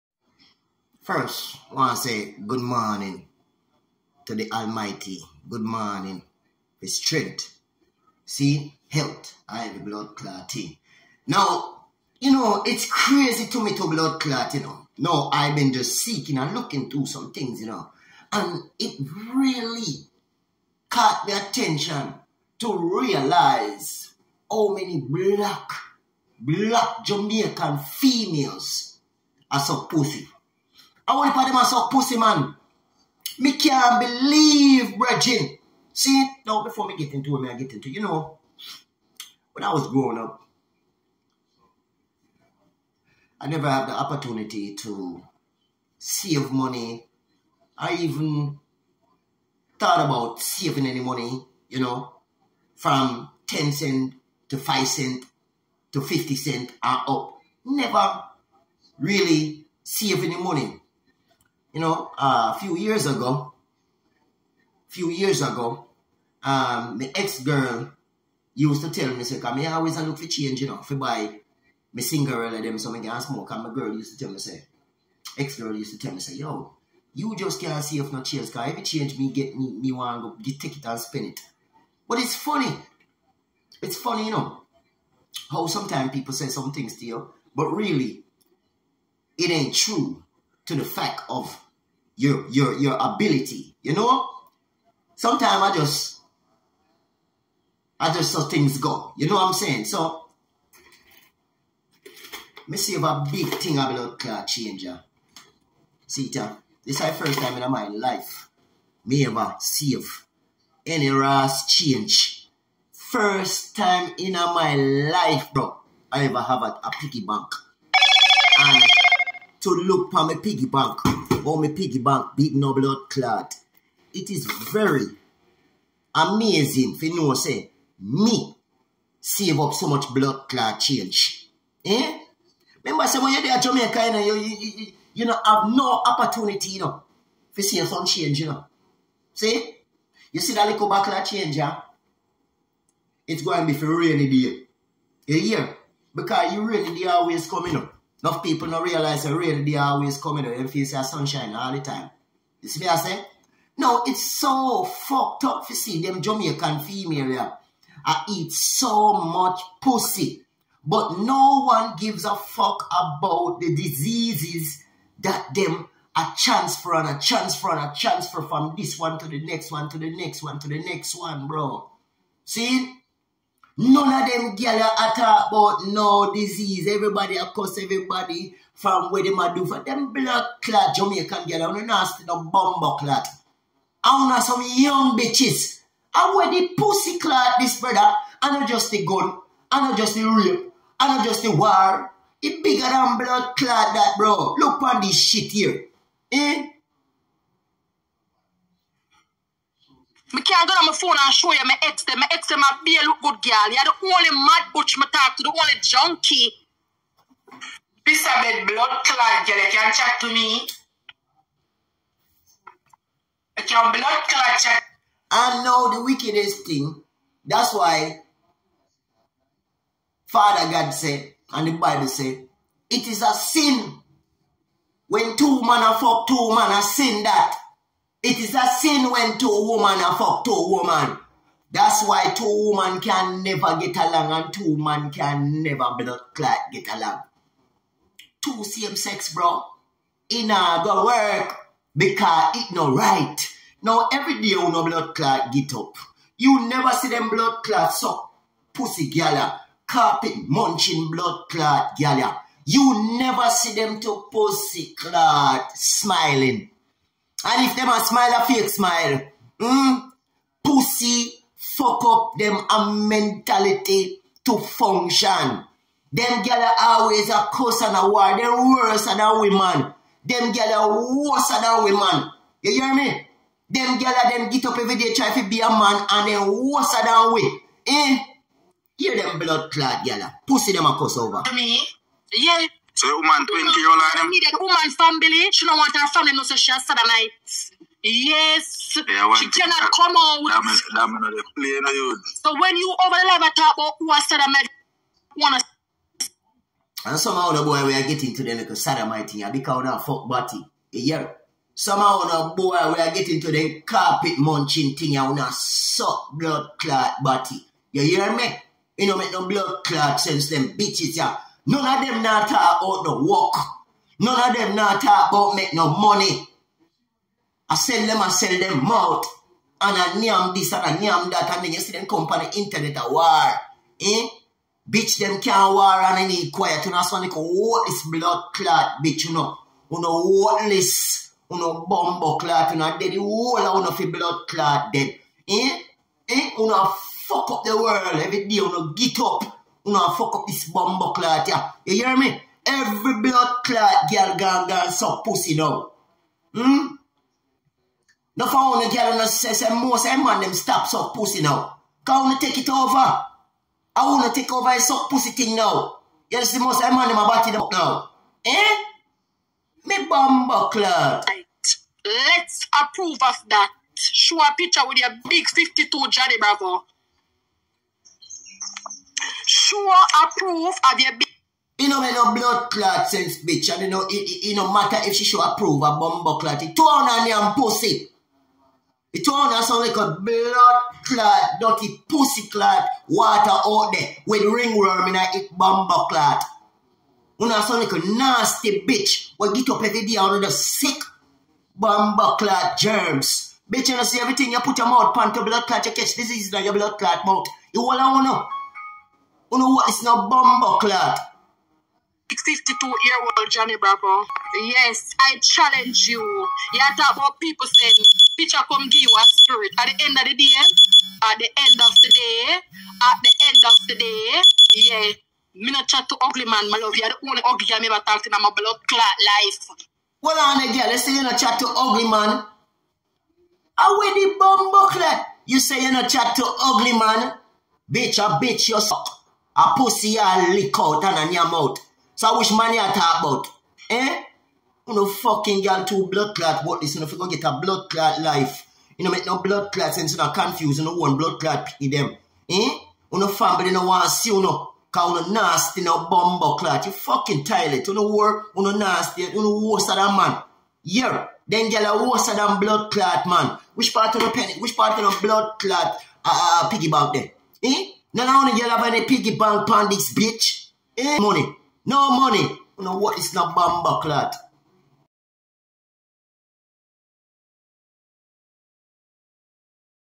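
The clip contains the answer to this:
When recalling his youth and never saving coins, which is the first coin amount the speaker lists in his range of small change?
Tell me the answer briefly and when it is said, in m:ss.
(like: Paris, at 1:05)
10 cents, at 0:53.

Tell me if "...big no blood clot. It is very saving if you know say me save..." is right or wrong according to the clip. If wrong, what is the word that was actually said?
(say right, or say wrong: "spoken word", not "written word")
wrong: "amazing", not "saving".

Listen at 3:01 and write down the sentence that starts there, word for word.
I don't ask the bumbo clad.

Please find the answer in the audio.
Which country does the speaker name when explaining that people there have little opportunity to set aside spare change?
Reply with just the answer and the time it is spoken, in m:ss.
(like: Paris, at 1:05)
Jamaica, at 2:13.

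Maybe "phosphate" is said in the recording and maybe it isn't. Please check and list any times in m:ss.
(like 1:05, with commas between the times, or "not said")
not said.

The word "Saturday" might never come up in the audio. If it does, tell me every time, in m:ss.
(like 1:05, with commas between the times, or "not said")
4:46.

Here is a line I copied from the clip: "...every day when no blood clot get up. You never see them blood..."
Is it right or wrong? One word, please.
right.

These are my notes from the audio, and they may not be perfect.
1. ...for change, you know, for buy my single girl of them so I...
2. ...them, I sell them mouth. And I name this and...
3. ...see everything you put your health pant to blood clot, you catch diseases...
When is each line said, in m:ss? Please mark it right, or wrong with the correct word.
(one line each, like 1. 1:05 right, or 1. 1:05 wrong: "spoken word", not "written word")
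1. 1:10 right
2. 5:18 right
3. 6:34 wrong: "mouth", not "health".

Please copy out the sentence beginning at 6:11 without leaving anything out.
You know, man, no blood clot sense, bitch.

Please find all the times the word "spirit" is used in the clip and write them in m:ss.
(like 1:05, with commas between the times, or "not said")
6:49.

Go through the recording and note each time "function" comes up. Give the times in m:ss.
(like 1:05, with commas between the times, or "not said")
4:24.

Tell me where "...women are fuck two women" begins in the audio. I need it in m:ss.
3:49.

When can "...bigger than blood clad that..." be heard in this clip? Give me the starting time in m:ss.
3:12.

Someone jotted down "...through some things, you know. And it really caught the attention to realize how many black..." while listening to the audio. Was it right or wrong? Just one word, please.
right.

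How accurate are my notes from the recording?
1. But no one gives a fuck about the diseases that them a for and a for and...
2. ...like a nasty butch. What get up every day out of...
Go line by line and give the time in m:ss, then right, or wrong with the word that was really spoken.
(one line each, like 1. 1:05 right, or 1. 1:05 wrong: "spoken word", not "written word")
1. 2:40 right
2. 6:27 wrong: "bitch", not "butch".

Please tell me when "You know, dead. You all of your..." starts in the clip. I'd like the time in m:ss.
5:32.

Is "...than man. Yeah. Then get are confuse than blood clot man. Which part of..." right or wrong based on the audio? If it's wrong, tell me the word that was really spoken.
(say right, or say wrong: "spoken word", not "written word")
wrong: "worse", not "confuse".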